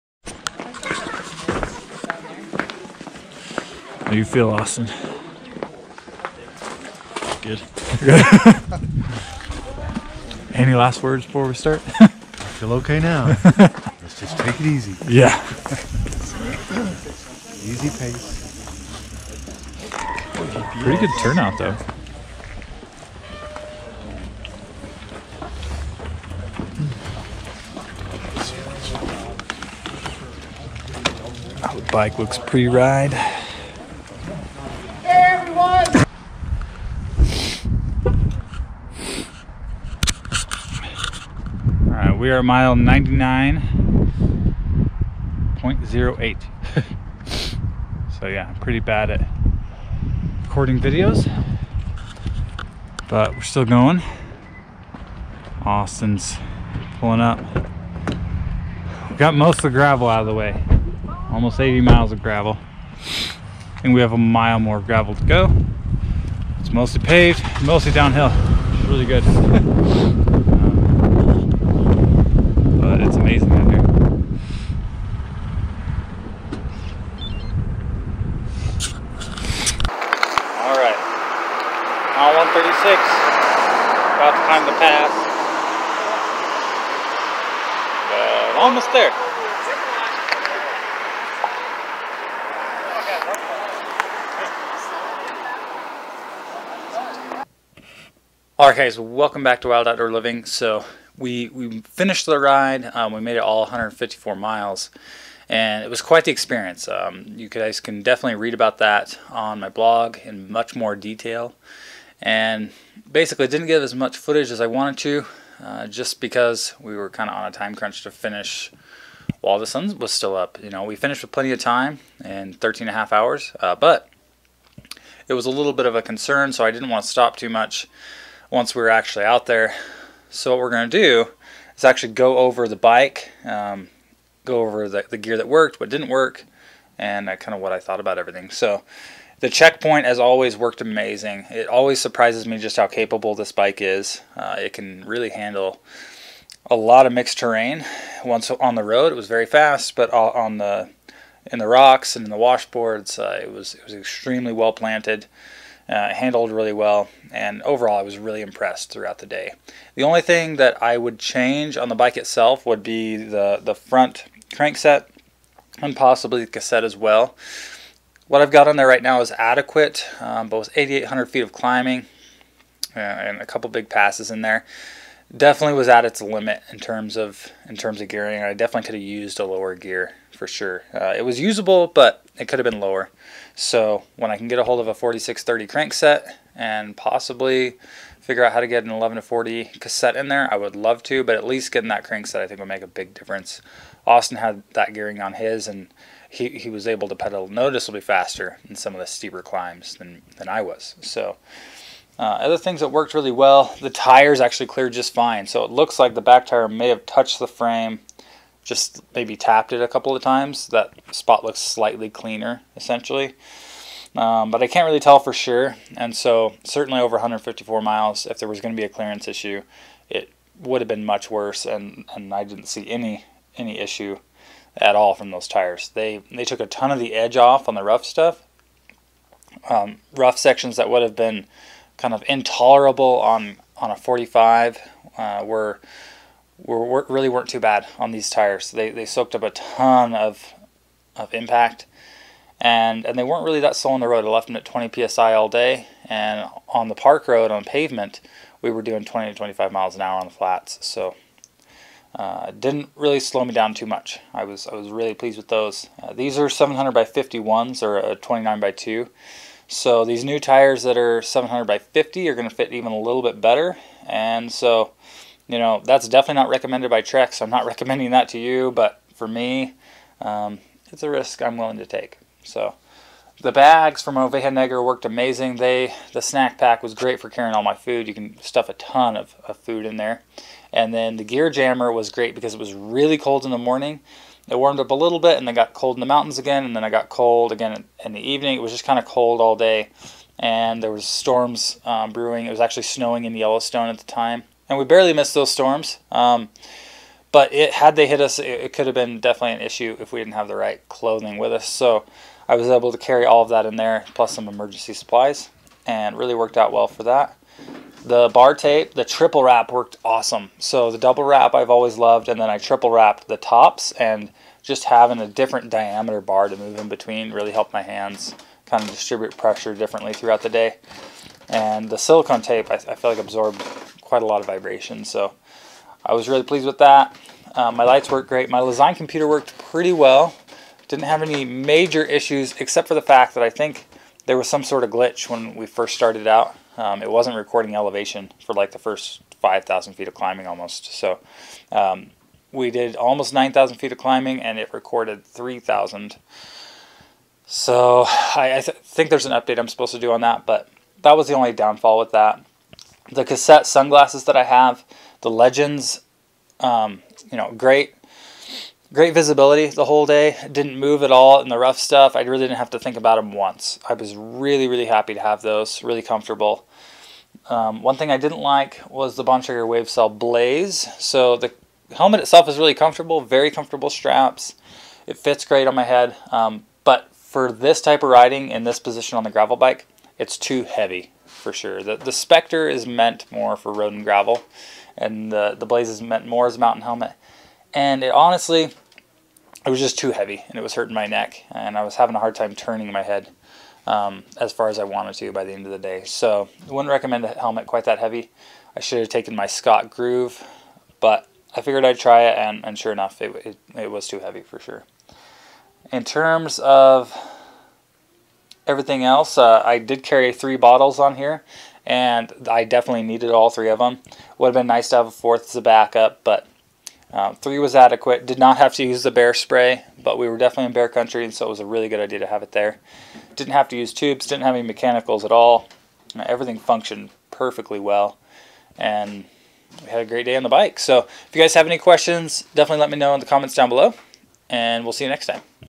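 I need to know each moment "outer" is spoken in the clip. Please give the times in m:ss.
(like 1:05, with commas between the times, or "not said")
not said.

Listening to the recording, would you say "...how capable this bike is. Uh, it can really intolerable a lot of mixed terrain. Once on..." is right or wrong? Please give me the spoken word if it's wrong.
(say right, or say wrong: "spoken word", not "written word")
wrong: "handle", not "intolerable".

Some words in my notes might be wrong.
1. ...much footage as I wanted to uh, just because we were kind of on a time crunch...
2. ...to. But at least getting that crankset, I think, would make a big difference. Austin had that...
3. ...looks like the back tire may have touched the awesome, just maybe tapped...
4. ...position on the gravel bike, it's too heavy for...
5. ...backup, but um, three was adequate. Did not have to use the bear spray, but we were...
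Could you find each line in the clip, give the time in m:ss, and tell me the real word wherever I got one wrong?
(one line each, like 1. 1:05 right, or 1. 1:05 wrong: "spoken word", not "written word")
1. 1:53 right
2. 3:11 right
3. 3:25 wrong: "frame", not "awesome"
4. 6:18 right
5. 6:55 right.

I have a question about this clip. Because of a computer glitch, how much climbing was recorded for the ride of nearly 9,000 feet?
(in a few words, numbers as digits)
3,000.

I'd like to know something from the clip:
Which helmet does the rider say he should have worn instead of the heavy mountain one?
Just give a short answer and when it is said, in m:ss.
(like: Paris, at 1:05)
Scott Groove, at 6:39.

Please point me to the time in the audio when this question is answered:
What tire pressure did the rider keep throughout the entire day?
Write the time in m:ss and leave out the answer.
4:04.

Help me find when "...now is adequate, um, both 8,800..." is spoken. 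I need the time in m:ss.
2:49.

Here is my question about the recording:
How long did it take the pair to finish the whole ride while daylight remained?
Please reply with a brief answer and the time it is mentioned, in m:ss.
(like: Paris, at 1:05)
13 and a half hours, at 2:02.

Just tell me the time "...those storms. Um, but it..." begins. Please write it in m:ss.
4:55.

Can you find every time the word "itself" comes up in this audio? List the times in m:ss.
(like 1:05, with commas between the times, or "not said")
2:42, 6:12.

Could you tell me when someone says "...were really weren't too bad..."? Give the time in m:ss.
3:56.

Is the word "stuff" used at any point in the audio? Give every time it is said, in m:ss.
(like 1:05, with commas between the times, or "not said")
3:48, 4:38, 6:01.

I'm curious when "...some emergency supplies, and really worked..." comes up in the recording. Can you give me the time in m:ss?
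5:04.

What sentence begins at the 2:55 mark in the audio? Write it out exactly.
Definitely was at its limit in terms of in terms of gearing.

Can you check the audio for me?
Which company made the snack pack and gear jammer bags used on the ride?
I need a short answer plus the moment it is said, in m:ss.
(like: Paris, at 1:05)
Oveja Negra, at 4:34.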